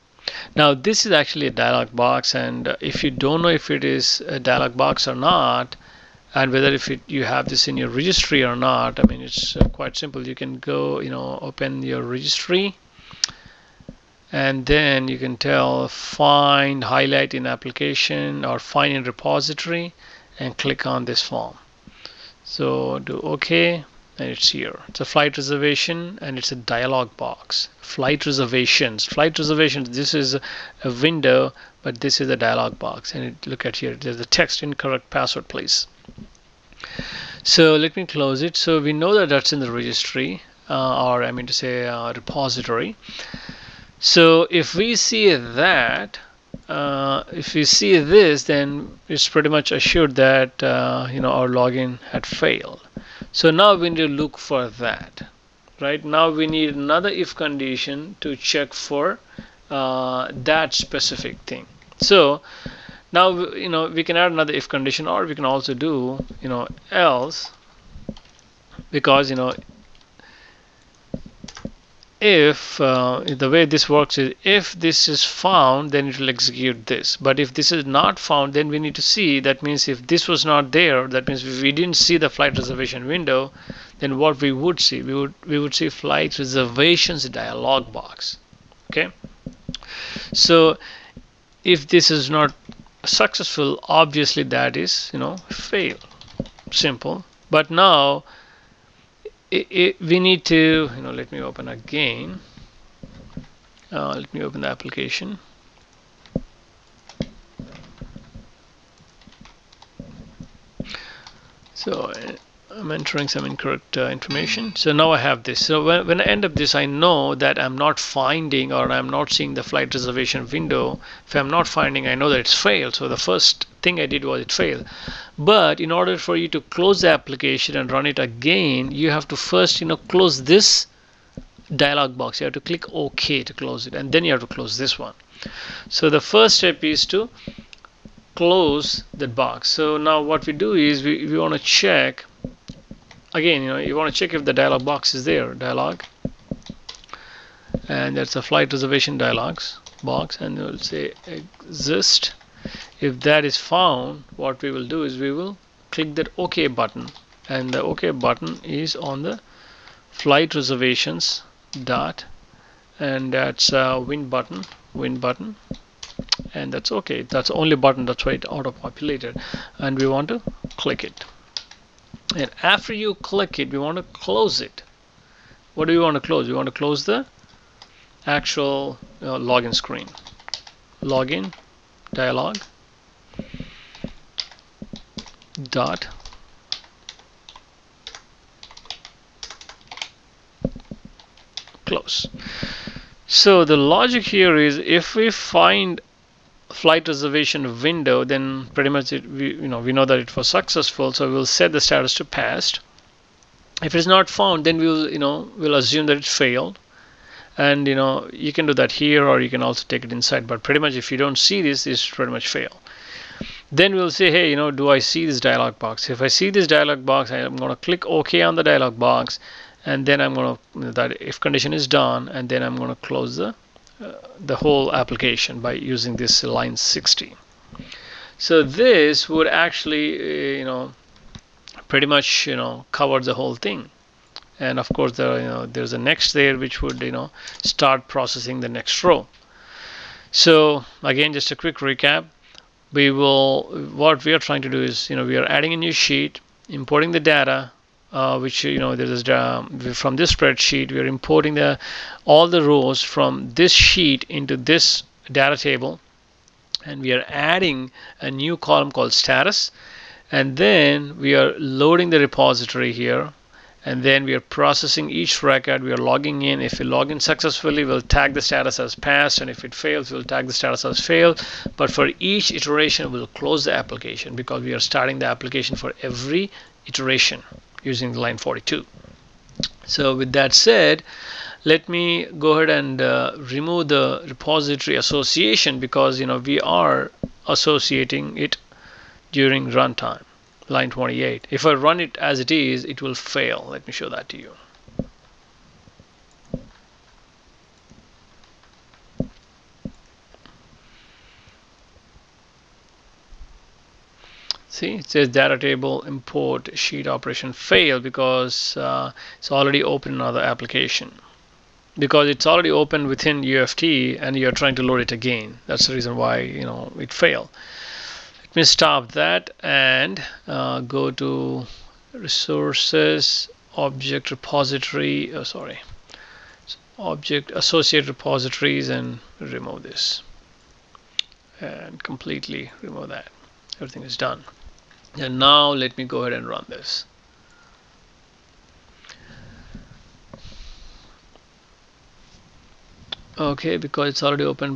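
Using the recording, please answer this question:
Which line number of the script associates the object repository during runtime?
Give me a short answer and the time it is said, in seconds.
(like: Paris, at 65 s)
28, at 290 s.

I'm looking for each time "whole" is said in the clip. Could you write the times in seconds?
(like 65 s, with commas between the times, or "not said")
224 s, 233 s.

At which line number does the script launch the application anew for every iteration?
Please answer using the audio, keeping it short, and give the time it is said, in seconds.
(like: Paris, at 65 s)
42, at 278 s.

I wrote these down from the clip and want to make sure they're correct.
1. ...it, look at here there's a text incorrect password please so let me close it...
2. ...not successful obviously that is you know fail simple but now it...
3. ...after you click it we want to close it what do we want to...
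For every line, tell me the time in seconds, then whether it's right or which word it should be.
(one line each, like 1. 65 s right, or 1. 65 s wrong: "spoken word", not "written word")
1. 33 s right
2. 92 s right
3. 172 s right.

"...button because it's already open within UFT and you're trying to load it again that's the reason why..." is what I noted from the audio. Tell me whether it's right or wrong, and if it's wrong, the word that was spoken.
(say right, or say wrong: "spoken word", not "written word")
wrong: "application", not "button".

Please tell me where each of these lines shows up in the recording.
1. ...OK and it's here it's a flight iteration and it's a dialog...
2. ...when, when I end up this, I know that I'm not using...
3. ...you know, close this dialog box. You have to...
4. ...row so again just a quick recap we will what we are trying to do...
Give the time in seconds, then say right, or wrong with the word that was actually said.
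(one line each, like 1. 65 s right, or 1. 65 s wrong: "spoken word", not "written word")
1. 23 s wrong: "reservation", not "iteration"
2. 115 s wrong: "finding", not "using"
3. 129 s right
4. 239 s right.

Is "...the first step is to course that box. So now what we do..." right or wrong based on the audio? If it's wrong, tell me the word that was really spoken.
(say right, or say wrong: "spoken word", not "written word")
wrong: "close", not "course".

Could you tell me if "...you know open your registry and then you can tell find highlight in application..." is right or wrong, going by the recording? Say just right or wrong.
right.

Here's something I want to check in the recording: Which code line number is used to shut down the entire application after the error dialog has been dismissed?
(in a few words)
60.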